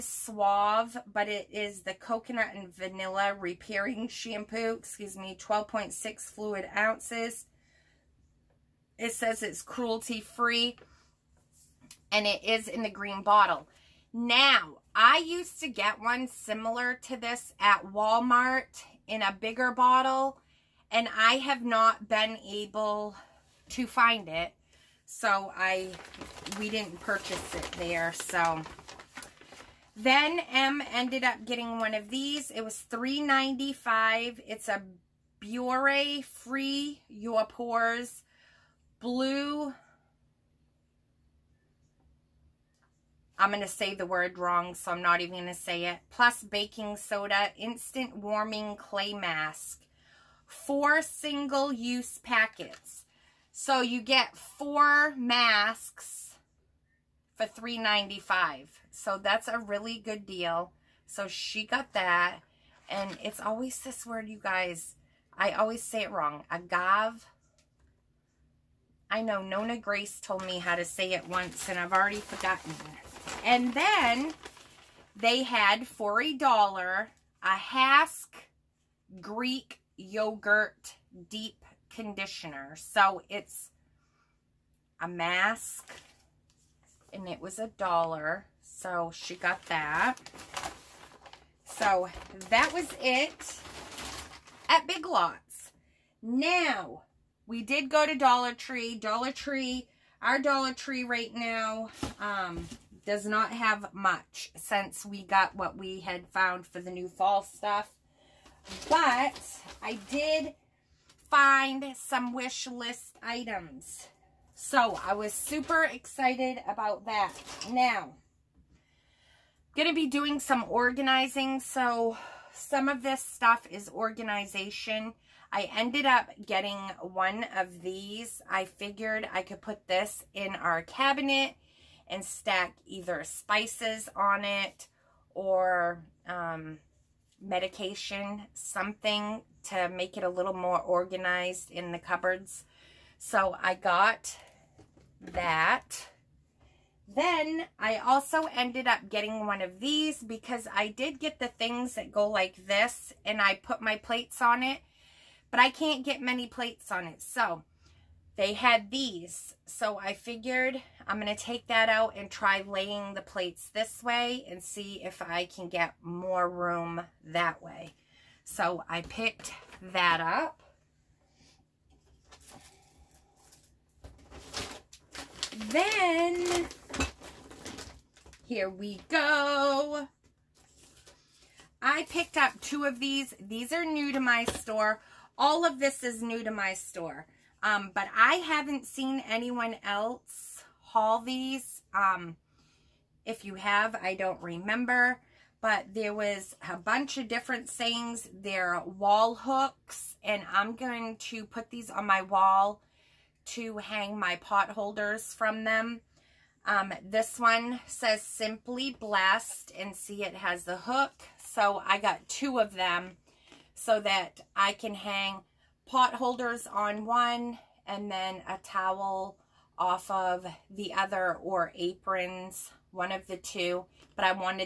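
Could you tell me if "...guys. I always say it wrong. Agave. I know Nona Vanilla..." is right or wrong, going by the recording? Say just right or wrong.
wrong.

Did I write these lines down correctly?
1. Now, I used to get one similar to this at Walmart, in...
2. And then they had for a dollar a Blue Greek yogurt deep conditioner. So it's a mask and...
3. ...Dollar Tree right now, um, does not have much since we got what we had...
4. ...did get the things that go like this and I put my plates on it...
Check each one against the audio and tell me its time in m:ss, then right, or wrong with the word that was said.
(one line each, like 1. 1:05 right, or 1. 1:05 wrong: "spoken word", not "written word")
1. 0:14 right
2. 1:13 wrong: "Hask", not "Blue"
3. 1:40 right
4. 2:30 right.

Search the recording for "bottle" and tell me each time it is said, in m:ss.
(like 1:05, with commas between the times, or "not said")
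0:13, 0:19.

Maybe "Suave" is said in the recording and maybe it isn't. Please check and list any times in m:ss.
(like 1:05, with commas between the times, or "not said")
0:00.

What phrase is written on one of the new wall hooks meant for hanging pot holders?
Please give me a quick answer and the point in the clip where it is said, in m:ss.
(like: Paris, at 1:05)
Simply Blessed, at 3:28.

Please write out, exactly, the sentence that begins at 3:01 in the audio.
I picked up two of these.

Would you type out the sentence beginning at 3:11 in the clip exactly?
Um, if you have, I don't remember.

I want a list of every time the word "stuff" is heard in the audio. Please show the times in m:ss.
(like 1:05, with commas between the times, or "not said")
1:47, 2:03.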